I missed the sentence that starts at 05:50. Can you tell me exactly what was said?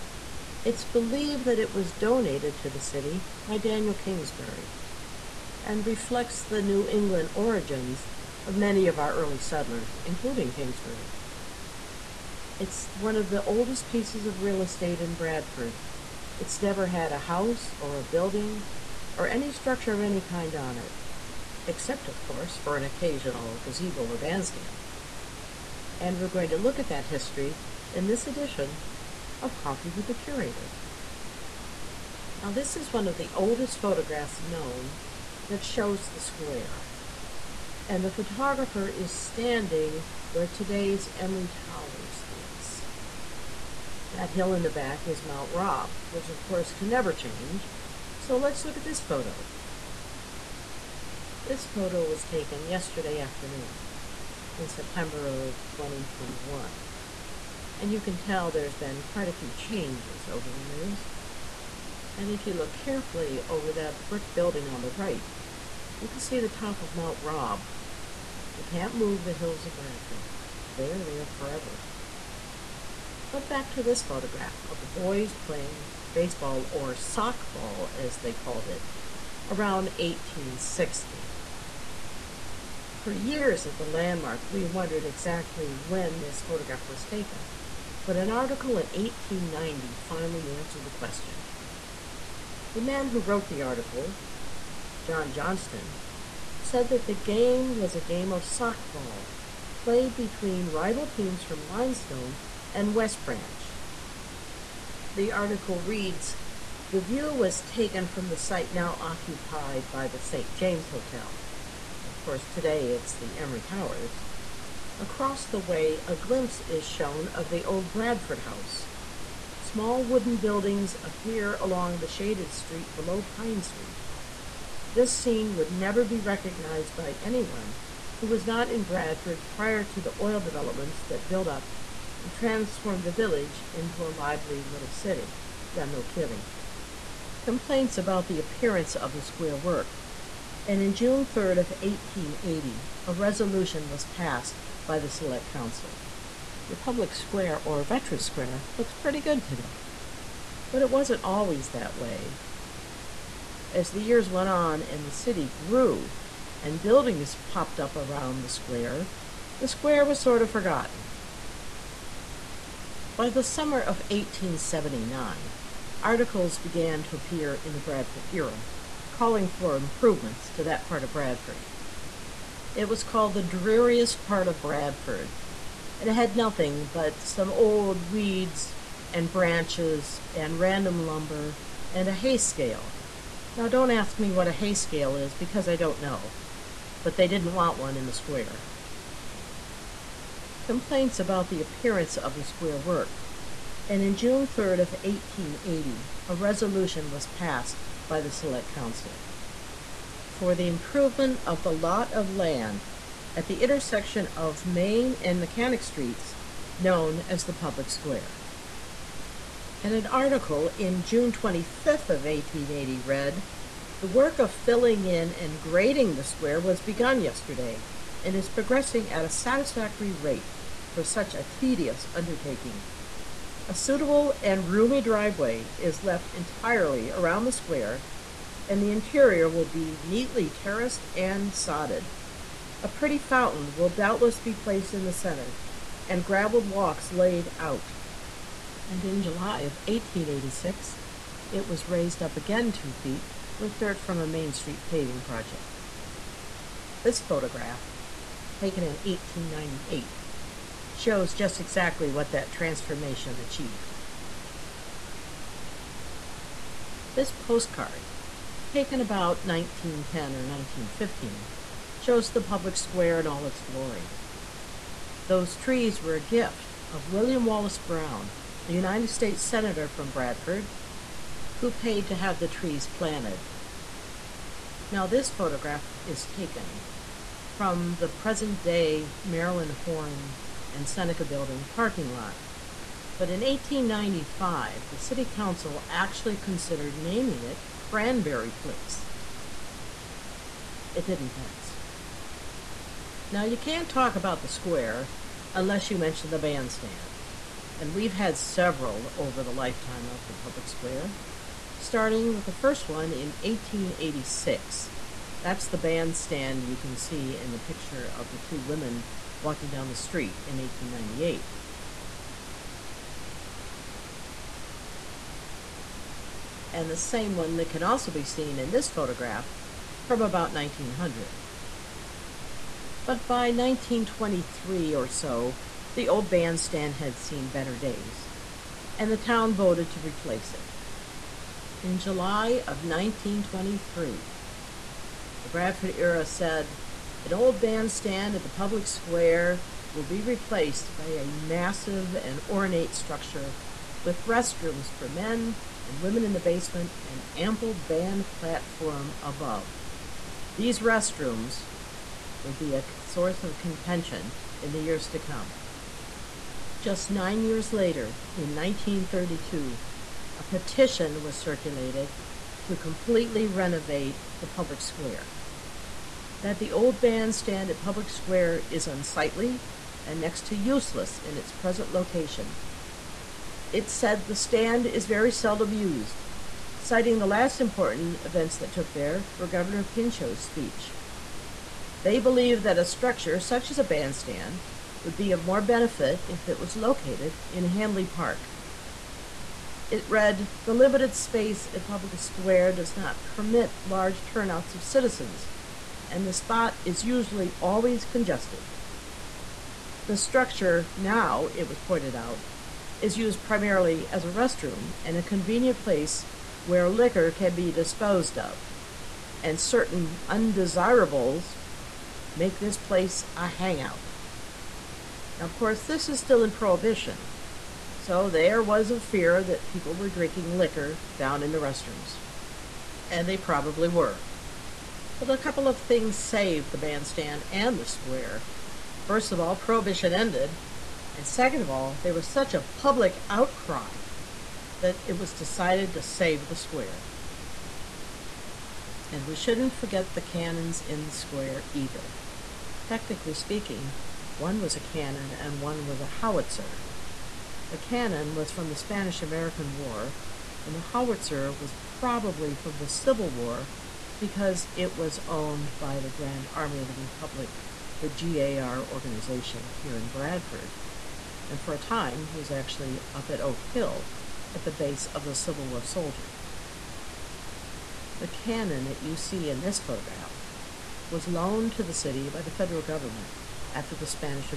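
These restrooms would be a source of contention in the years to come.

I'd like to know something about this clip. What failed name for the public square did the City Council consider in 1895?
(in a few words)
Cranberry Place.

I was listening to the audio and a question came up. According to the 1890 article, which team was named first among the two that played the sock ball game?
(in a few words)
Limestone.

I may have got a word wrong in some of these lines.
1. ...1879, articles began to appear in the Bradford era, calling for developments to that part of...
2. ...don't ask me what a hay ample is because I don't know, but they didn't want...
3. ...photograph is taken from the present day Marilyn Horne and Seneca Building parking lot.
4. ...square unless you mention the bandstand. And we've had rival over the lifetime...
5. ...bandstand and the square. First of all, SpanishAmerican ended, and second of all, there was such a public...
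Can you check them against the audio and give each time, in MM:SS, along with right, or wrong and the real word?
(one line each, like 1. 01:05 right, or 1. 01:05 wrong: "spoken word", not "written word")
1. 02:44 wrong: "improvements", not "developments"
2. 03:03 wrong: "scale", not "ample"
3. 04:35 right
4. 04:54 wrong: "several", not "rival"
5. 07:06 wrong: "Prohibition", not "SpanishAmerican".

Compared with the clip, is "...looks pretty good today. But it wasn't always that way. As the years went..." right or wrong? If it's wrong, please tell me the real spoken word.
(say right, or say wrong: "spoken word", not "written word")
right.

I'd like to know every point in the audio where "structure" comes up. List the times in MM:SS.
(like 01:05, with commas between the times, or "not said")
00:19, 05:42, 06:22, 06:40.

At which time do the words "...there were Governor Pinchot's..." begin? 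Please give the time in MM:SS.
06:18.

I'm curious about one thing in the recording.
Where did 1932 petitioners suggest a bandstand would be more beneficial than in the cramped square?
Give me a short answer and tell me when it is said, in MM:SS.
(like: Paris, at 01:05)
Hanley Park, at 06:27.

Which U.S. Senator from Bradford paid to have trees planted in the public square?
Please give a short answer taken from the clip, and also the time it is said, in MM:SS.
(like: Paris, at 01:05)
William Wallace Brown, at 04:27.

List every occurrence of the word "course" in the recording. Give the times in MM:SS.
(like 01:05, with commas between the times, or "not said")
00:22, 00:46, 01:52, 06:55.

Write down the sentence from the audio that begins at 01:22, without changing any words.
For years at the landmark, we wondered exactly when this photograph was taken, but an article in 1890 finally answered the question.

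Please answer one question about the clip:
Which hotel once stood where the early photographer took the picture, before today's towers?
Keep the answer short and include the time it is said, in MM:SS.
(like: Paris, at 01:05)
St. James Hotel, at 01:50.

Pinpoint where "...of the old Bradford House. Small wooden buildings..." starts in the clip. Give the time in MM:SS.
01:57.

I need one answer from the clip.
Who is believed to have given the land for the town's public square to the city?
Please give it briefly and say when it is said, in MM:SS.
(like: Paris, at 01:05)
Daniel Kingsbury, at 00:03.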